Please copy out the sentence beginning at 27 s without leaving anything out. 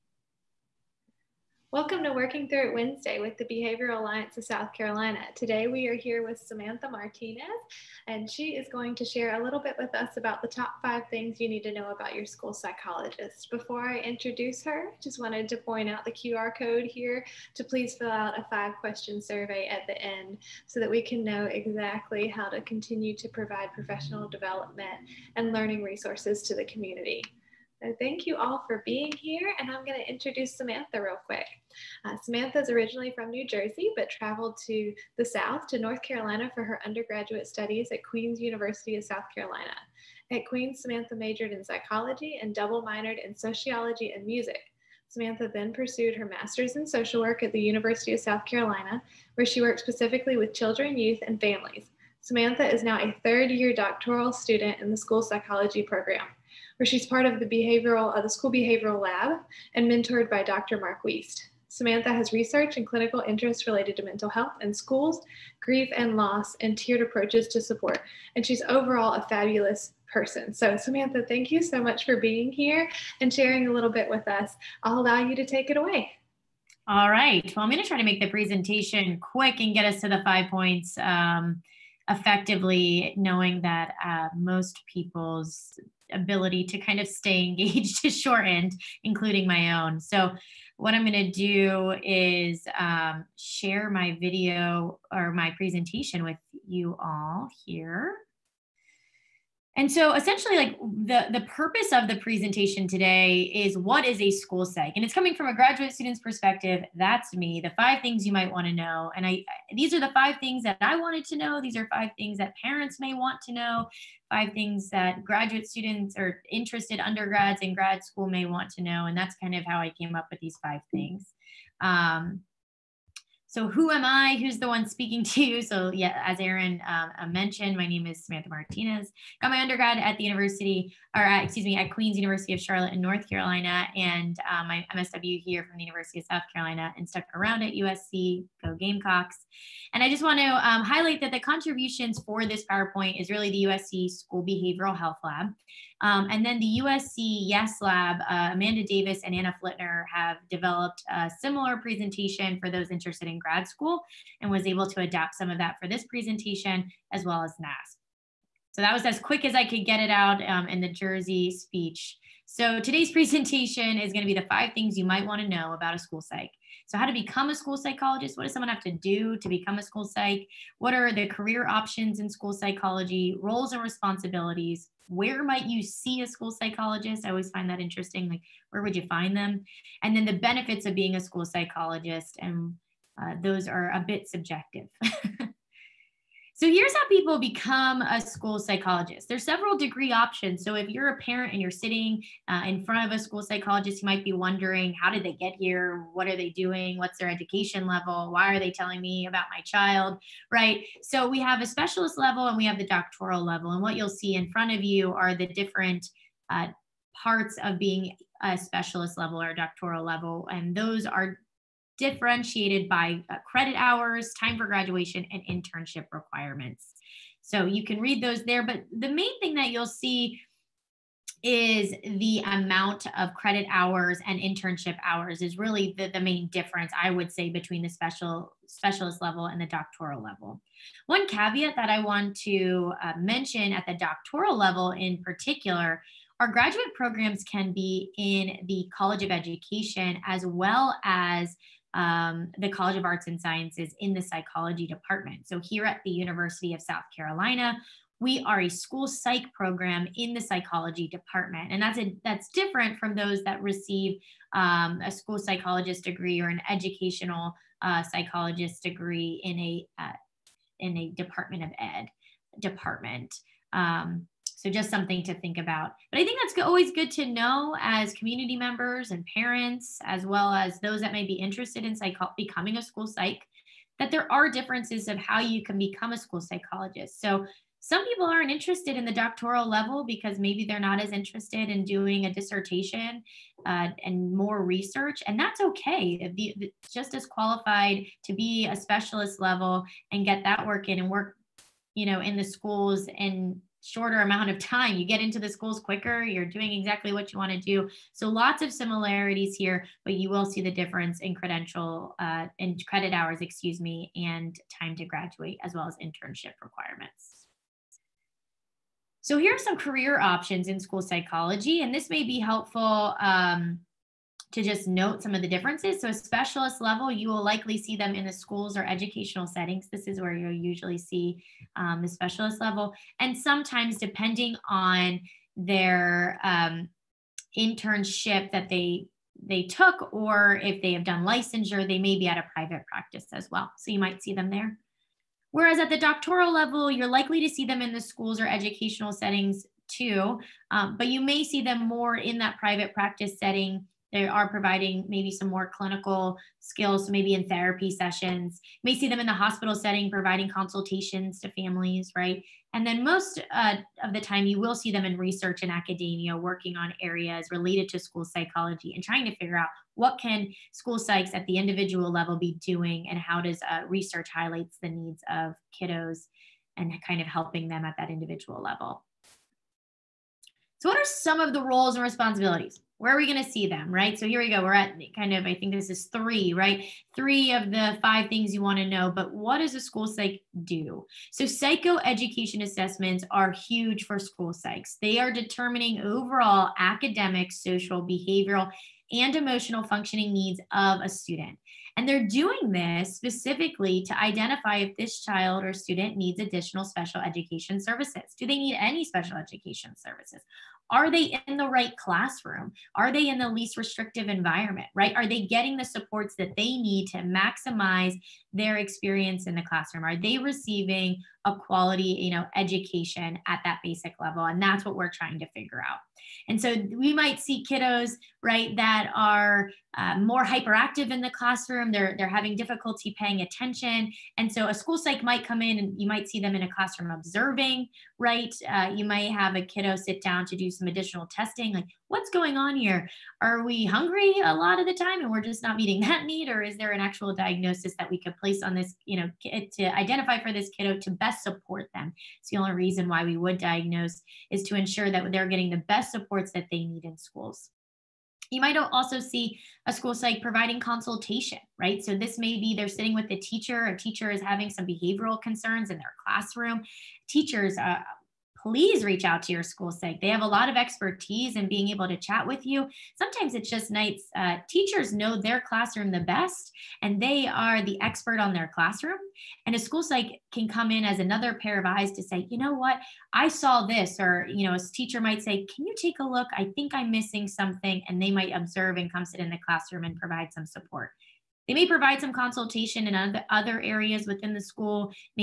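So thank you all for being here, and I'm going to introduce Samantha real quick.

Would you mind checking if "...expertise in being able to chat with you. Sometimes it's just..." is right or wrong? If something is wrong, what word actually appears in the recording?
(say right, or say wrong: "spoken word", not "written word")
right.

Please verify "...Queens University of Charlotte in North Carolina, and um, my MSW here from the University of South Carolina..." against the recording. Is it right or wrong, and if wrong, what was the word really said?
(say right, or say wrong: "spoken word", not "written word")
right.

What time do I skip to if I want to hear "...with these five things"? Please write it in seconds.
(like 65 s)
120 s.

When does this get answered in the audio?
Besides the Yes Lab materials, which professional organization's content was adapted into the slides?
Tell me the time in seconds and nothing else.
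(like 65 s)
157 s.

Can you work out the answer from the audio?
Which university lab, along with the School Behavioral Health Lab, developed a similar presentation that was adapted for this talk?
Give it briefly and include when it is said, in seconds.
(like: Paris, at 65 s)
USC Yes Lab, at 146 s.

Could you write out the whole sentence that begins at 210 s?
And those are differentiated by uh, credit hours, time for graduation, and internship requirements.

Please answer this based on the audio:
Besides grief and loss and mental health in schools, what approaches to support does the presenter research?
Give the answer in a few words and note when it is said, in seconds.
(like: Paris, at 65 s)
tiered approaches, at 66 s.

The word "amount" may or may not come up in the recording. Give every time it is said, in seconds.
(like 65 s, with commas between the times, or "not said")
222 s, 294 s.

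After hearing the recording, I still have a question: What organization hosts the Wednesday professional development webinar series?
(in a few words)
Behavioral Alliance of South Carolina.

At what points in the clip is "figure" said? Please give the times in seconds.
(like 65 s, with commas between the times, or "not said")
359 s, 415 s.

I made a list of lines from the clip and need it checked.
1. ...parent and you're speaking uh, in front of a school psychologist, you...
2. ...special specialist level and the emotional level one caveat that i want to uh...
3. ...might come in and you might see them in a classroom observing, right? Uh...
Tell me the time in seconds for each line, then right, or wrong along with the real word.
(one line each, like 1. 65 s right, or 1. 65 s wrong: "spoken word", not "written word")
1. 191 s wrong: "sitting", not "speaking"
2. 227 s wrong: "doctoral", not "emotional"
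3. 425 s right.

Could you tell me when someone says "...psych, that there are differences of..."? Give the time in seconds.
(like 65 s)
273 s.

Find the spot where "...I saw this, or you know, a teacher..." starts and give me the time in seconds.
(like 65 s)
473 s.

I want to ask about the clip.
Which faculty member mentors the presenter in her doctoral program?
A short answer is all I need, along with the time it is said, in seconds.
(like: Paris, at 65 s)
Dr. Mark Weist, at 60 s.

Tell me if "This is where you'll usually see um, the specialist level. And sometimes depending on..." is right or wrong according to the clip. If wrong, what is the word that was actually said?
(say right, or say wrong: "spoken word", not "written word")
right.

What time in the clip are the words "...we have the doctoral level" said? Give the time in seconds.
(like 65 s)
202 s.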